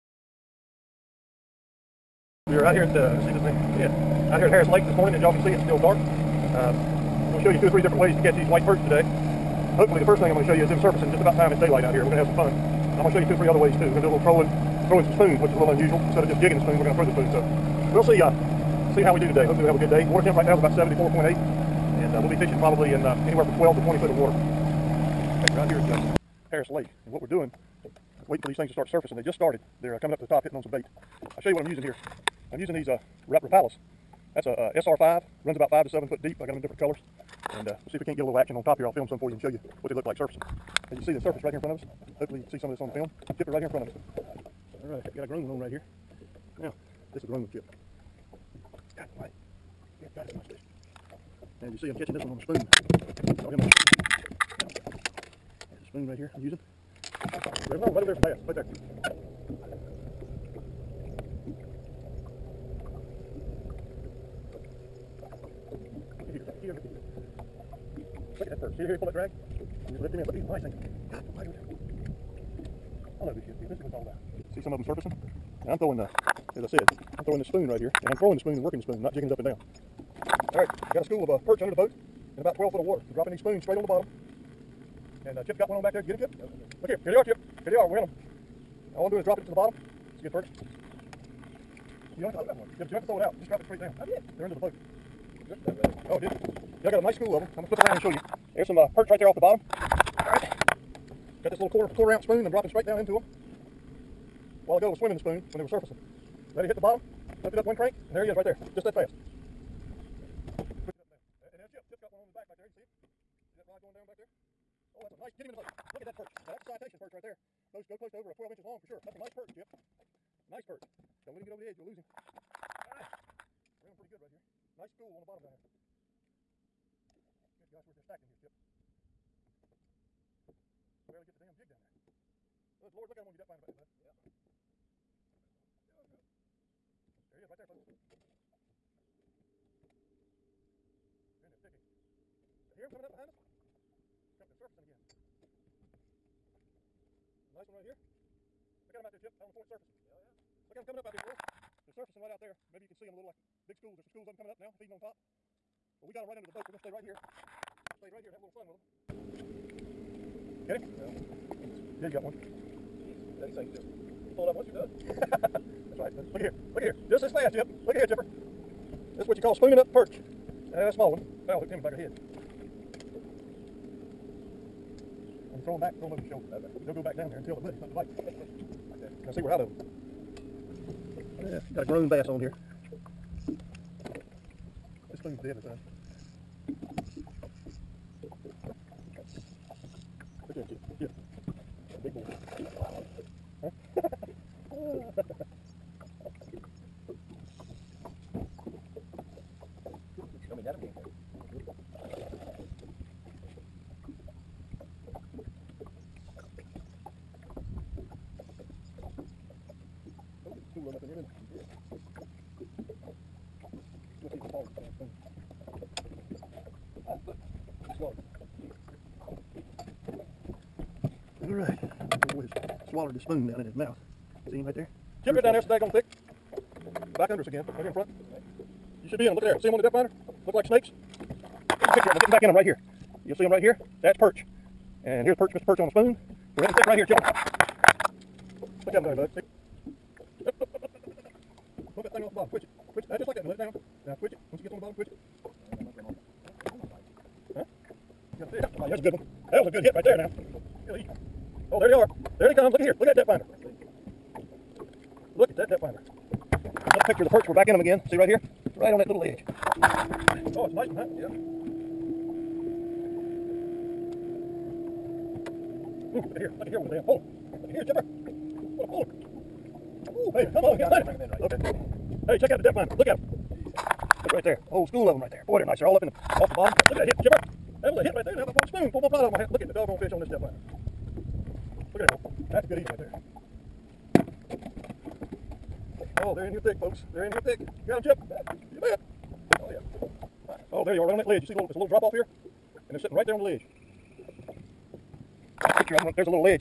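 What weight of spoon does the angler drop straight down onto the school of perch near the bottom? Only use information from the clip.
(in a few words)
quarter ounce.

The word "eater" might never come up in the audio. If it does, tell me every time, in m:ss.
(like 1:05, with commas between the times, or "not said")
4:42.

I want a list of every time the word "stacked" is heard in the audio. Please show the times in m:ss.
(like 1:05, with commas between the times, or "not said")
2:08.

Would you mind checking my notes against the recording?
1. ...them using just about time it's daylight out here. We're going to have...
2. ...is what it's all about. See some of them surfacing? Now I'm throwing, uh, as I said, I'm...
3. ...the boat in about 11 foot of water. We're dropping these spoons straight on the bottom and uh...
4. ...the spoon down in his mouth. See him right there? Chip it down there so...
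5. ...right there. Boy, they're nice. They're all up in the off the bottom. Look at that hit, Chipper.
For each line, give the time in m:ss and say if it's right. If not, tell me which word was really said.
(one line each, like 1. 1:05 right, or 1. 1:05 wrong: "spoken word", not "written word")
1. 0:10 wrong: "surfacing", not "using"
2. 1:13 right
3. 1:21 wrong: "12", not "11"
4. 3:43 right
5. 4:35 right.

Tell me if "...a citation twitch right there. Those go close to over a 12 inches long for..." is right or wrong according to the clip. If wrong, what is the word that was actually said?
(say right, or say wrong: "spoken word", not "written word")
wrong: "perch", not "twitch".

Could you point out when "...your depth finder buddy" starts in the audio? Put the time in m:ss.
2:13.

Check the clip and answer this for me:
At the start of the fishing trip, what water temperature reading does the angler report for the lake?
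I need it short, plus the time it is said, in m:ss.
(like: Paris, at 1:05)
74.8, at 0:20.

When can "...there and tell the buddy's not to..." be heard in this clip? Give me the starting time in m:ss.
2:57.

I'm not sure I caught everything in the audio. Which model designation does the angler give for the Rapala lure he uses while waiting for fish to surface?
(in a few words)
SR5.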